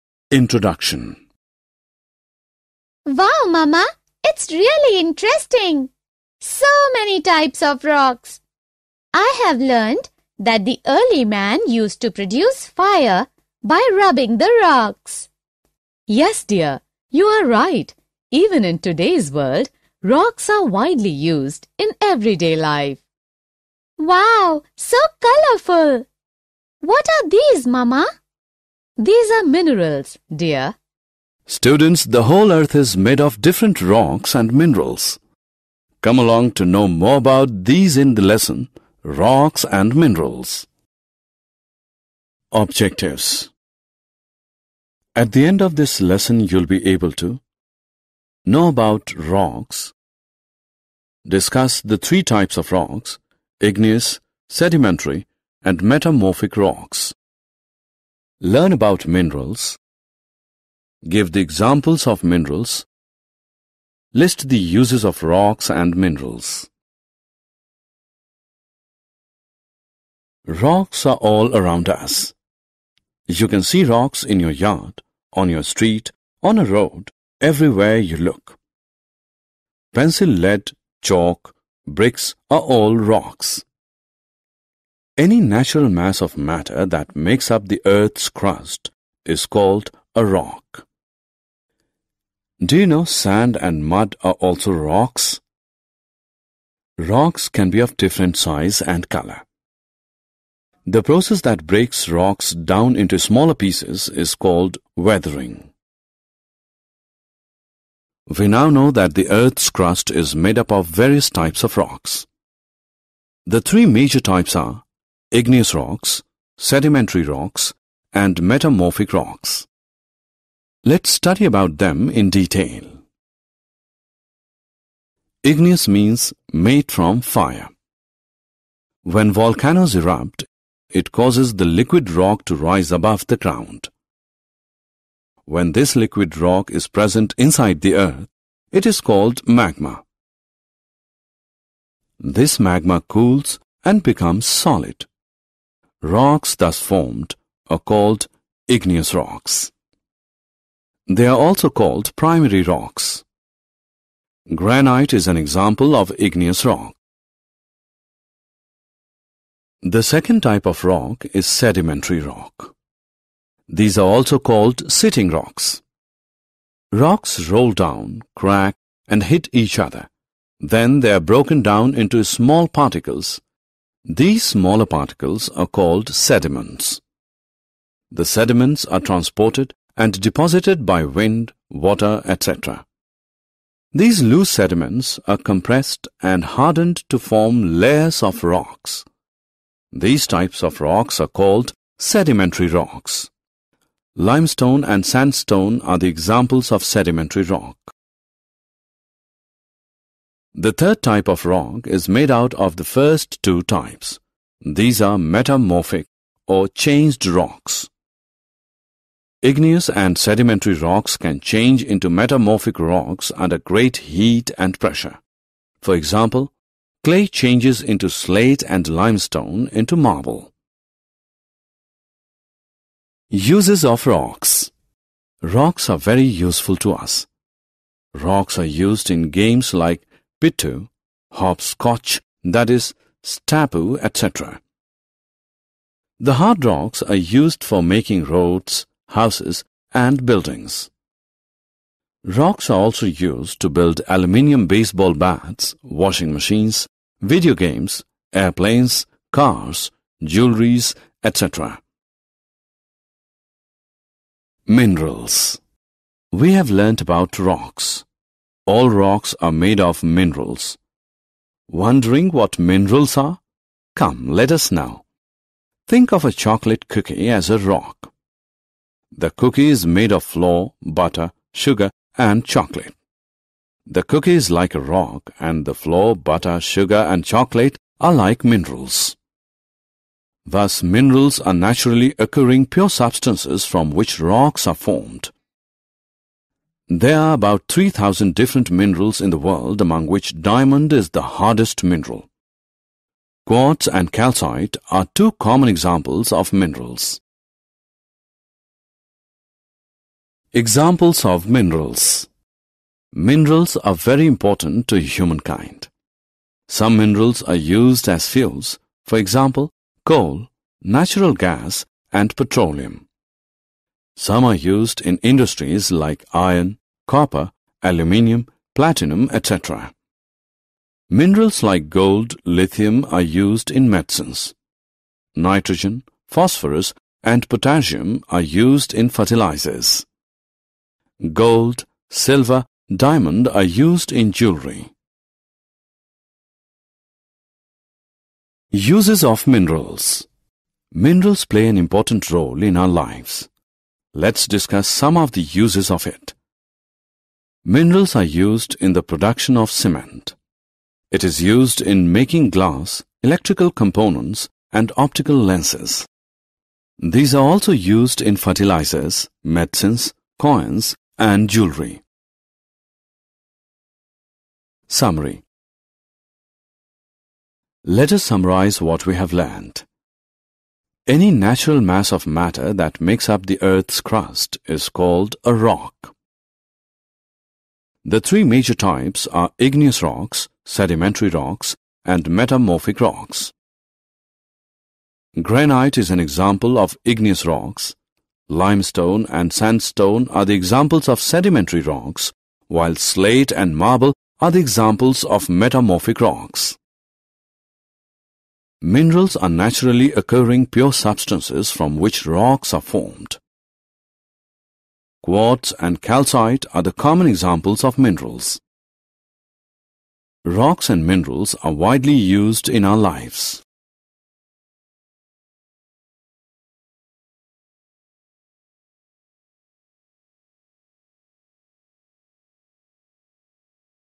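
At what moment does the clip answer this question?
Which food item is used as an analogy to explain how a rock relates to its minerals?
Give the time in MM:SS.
04:26.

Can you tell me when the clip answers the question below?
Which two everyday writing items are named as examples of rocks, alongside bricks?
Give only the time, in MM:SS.
01:19.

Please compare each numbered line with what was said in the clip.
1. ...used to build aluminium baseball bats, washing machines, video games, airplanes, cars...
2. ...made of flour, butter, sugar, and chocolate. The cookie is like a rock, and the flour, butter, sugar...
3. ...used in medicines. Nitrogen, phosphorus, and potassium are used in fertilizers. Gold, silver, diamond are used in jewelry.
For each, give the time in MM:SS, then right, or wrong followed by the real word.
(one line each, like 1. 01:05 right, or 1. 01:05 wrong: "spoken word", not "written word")
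1. 04:03 right
2. 04:29 right
3. 05:23 right.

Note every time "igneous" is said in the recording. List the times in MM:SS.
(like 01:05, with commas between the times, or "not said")
00:53, 01:55, 02:05, 02:28, 02:36, 03:29, 06:19, 06:27.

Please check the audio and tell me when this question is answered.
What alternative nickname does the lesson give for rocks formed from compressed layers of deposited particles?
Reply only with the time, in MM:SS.
02:44.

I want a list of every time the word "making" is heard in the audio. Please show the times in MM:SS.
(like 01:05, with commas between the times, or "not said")
03:57, 05:52.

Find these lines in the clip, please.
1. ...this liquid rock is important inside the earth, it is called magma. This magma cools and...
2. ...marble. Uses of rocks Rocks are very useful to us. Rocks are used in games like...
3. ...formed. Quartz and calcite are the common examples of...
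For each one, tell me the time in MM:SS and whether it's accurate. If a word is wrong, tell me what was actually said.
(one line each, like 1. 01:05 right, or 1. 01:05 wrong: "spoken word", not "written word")
1. 02:15 wrong: "present", not "important"
2. 03:39 right
3. 06:42 right.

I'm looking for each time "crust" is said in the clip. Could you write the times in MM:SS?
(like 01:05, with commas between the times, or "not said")
01:28, 01:49, 06:14.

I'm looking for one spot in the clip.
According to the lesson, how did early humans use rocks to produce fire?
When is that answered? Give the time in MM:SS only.
00:13.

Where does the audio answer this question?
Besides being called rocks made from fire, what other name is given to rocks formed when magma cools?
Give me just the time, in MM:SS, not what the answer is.
02:32.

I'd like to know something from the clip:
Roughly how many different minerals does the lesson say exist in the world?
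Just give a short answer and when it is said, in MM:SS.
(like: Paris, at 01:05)
3,000, at 04:47.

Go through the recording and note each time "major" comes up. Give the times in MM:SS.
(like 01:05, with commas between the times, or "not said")
01:53, 06:18.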